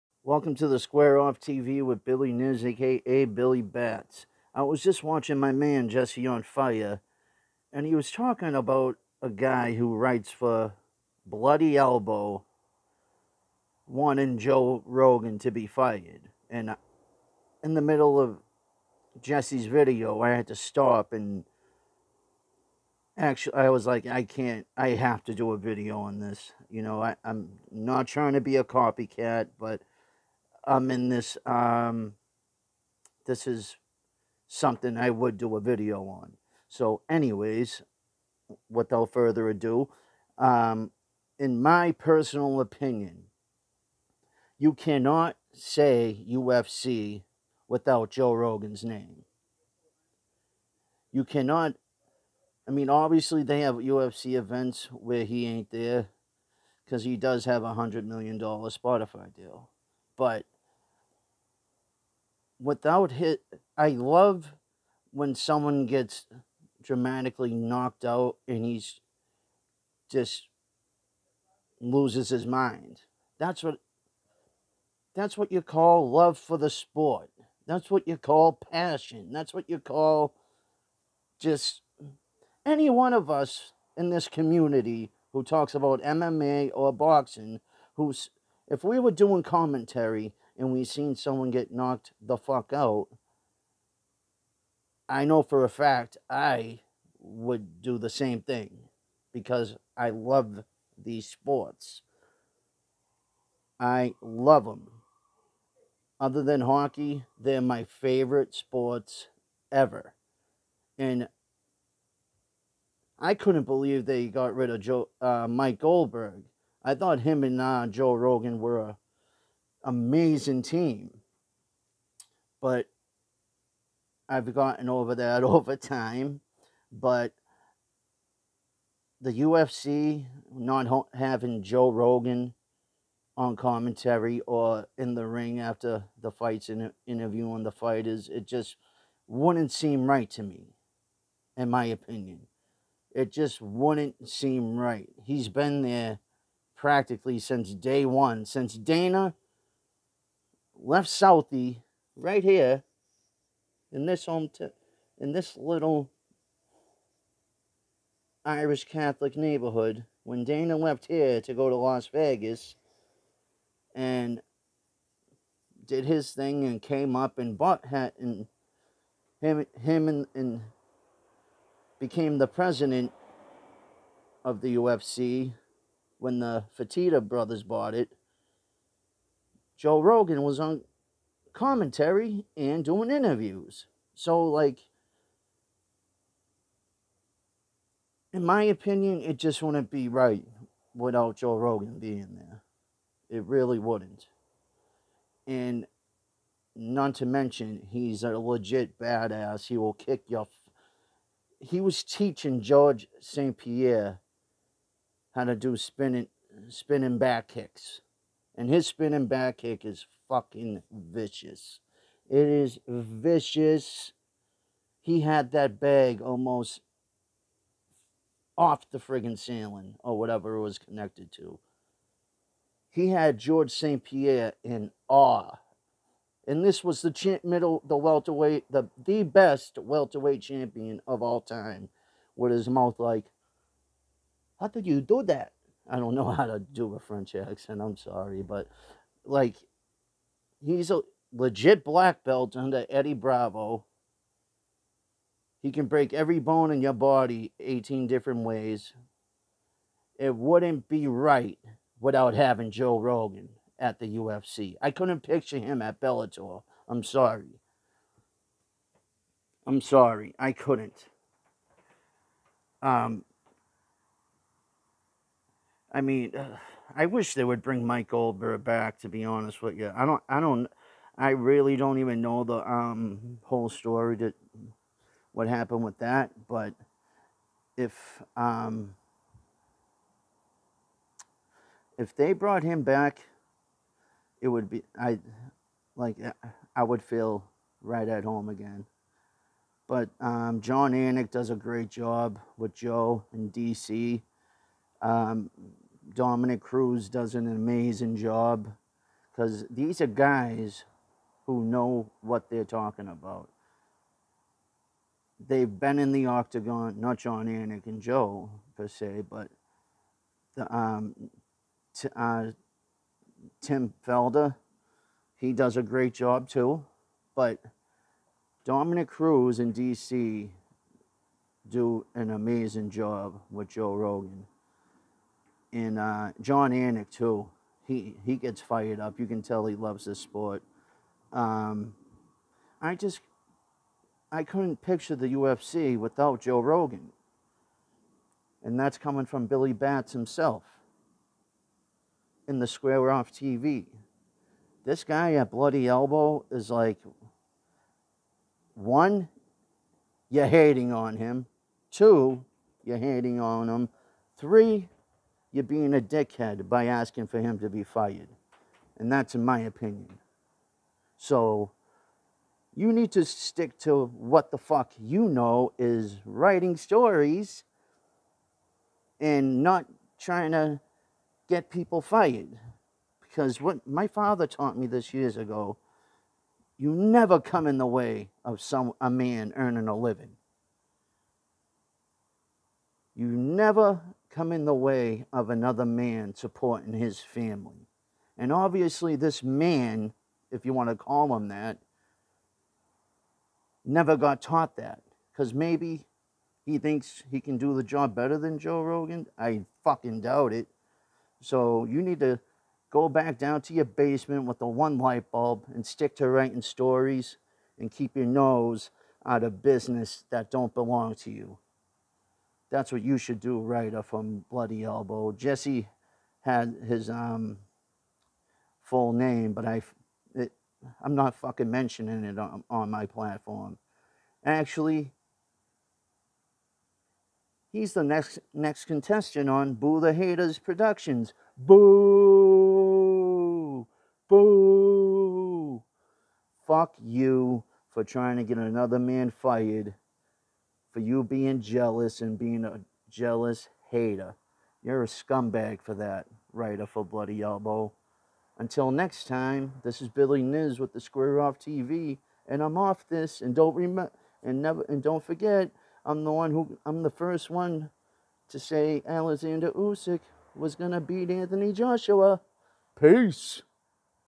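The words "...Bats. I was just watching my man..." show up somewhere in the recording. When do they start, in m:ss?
0:03.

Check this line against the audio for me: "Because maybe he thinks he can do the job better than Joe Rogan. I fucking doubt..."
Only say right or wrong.
right.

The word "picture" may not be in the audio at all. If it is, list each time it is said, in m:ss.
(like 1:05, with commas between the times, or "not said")
4:15, 5:34.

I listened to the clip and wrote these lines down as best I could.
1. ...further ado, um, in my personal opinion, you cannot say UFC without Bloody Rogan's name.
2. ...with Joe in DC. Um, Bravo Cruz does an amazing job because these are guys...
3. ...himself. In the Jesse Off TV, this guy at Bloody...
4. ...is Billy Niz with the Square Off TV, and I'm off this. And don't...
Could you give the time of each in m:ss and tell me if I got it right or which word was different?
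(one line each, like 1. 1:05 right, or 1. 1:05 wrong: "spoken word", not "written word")
1. 0:39 wrong: "Joe", not "Bloody"
2. 4:52 wrong: "Dominick", not "Bravo"
3. 5:40 wrong: "Square", not "Jesse"
4. 7:30 right.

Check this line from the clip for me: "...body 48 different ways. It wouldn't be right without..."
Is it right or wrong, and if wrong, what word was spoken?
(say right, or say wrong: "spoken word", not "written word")
wrong: "18", not "48".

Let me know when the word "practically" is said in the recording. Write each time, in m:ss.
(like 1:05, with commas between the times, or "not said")
2:26.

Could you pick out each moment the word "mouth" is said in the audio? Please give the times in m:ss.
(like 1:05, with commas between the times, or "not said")
3:52.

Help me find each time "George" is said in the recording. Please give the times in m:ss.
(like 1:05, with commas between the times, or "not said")
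3:22, 3:43.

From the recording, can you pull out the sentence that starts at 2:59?
Joe Rogan was on commentary and doing interviews.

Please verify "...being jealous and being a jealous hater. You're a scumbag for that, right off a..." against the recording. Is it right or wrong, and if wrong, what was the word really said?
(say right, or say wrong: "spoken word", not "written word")
right.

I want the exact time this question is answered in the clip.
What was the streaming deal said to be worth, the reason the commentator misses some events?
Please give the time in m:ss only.
0:57.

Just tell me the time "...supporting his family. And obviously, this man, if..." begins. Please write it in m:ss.
6:26.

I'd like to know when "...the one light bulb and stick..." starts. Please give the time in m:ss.
6:44.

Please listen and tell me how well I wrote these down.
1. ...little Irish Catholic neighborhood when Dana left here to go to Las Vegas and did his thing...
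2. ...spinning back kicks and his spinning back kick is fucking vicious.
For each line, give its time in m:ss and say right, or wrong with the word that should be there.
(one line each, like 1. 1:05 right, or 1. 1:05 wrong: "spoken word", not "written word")
1. 2:35 right
2. 3:26 right.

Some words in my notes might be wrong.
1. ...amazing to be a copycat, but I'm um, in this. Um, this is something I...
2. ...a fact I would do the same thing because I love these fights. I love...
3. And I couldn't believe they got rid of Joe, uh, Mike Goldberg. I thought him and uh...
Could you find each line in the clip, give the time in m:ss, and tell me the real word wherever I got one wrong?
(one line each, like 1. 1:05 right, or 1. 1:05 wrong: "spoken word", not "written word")
1. 0:28 wrong: "trying", not "amazing"
2. 1:35 wrong: "sports", not "fights"
3. 1:50 right.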